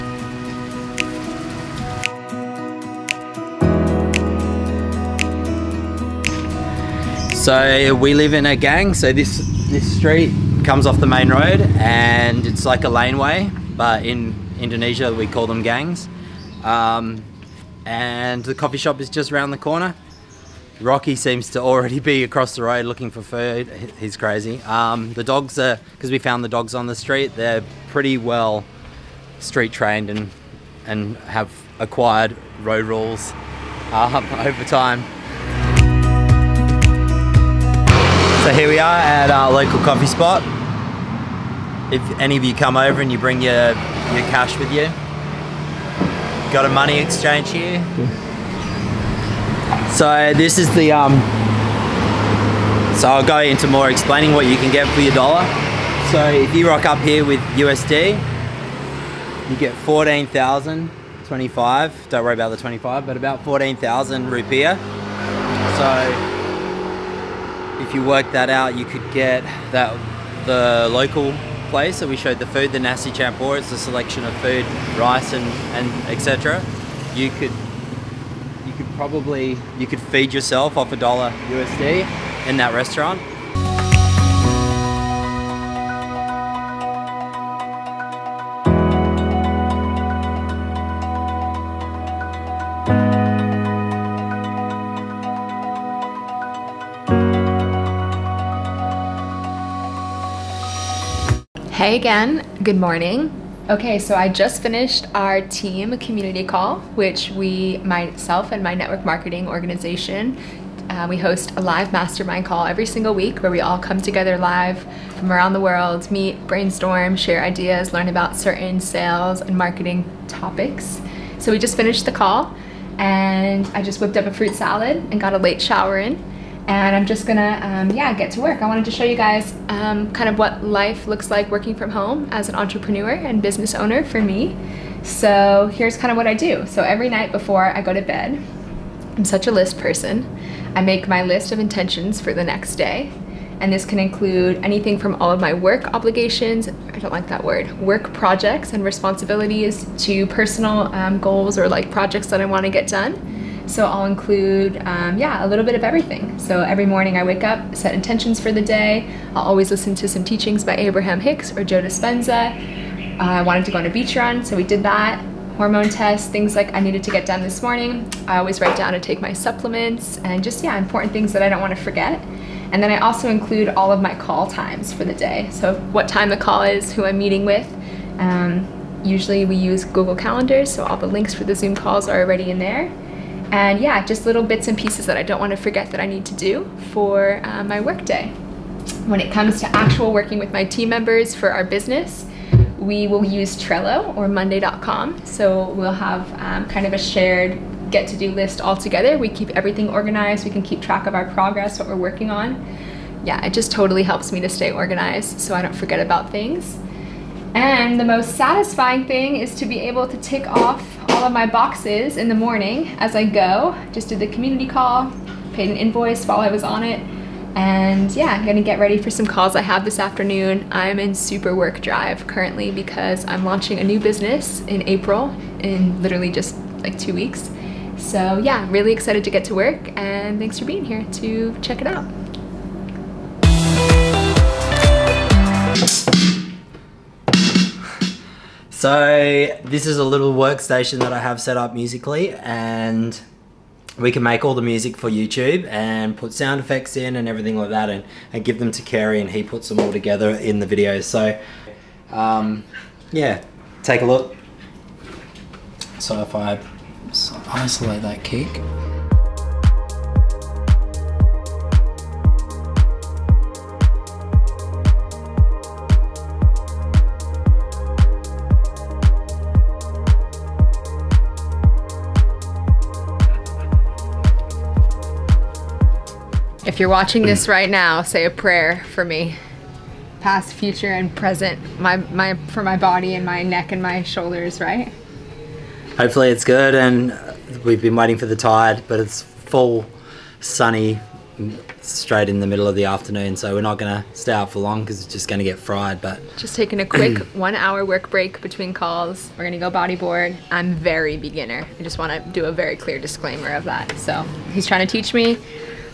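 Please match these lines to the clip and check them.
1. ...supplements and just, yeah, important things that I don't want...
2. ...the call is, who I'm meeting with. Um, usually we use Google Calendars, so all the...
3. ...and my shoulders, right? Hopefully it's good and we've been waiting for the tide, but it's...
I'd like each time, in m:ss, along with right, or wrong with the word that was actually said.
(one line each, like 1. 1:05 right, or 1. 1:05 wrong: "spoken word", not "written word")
1. 2:49 right
2. 2:56 right
3. 4:43 right.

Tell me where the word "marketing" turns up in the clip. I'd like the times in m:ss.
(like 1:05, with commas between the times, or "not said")
1:49, 1:59.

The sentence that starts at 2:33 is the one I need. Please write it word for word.
So I'll include, um, yeah, a little bit of everything.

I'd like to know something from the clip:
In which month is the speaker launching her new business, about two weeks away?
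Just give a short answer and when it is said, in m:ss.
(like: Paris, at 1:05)
April, at 3:44.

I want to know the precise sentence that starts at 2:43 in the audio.
Uh, I wanted to go on a beach run, so we did that.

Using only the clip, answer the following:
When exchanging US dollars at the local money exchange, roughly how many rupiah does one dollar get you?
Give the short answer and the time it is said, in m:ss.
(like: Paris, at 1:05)
14,025, at 0:59.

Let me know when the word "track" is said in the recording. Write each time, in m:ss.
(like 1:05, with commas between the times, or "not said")
3:20.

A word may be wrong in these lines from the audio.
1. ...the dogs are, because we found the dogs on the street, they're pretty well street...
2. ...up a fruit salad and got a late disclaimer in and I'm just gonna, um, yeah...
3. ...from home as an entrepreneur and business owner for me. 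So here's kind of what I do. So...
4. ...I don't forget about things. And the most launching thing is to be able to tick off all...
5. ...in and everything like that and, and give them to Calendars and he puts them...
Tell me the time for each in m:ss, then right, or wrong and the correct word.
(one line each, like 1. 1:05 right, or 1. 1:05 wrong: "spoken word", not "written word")
1. 0:25 right
2. 2:04 wrong: "shower", not "disclaimer"
3. 2:11 right
4. 3:25 wrong: "satisfying", not "launching"
5. 4:06 wrong: "Kerry", not "Calendars".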